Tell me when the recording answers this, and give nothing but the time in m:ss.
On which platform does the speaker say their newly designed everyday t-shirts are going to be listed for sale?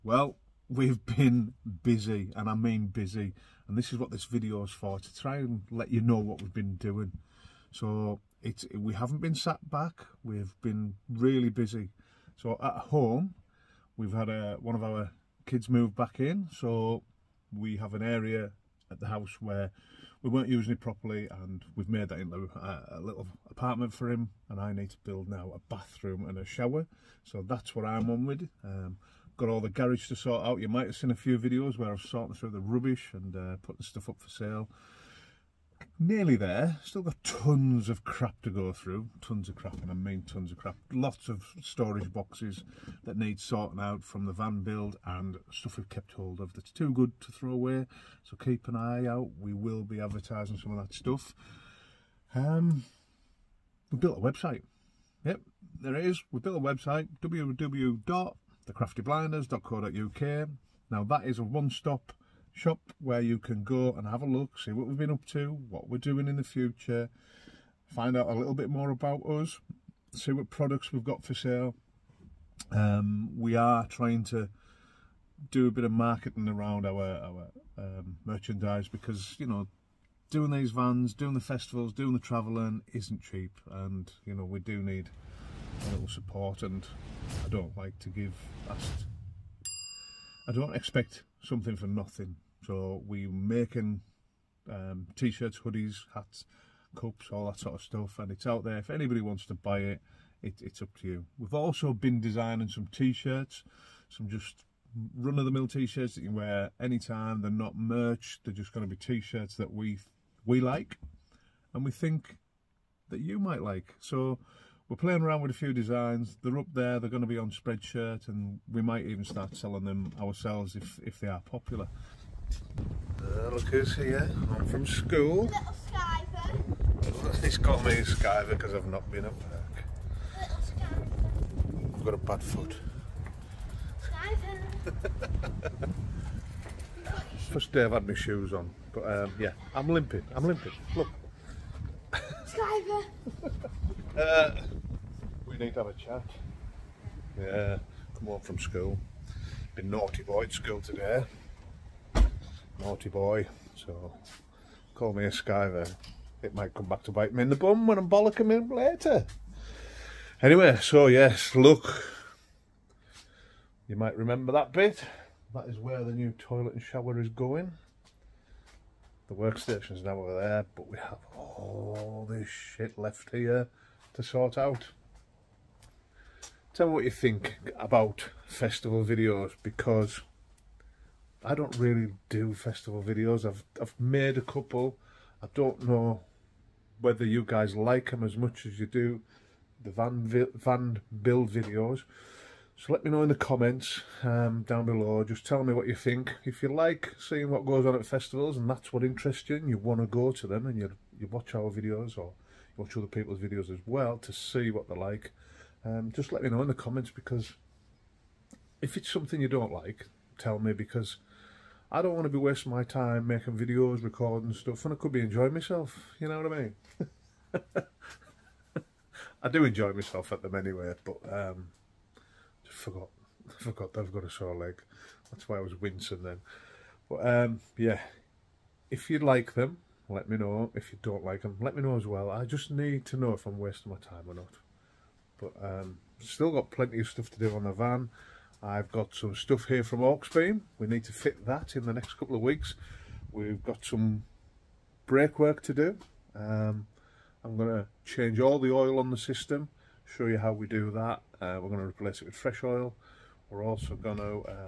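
1:57.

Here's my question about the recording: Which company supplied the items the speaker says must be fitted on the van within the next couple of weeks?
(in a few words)
Hawksbeam.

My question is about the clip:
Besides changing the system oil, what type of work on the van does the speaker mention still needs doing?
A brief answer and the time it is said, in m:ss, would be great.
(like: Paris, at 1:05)
brake work, at 4:05.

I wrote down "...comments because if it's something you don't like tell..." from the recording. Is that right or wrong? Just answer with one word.
right.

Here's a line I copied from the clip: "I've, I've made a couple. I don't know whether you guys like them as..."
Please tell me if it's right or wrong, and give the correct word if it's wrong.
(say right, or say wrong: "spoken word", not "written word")
right.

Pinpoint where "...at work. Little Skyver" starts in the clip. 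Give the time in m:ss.
2:09.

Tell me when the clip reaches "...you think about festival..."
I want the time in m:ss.
2:57.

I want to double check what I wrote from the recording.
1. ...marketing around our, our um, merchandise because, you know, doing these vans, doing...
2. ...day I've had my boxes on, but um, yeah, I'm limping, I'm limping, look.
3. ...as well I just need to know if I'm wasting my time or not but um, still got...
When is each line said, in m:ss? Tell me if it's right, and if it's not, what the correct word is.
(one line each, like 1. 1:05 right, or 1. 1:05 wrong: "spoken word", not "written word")
1. 1:15 right
2. 2:17 wrong: "shoes", not "boxes"
3. 3:51 right.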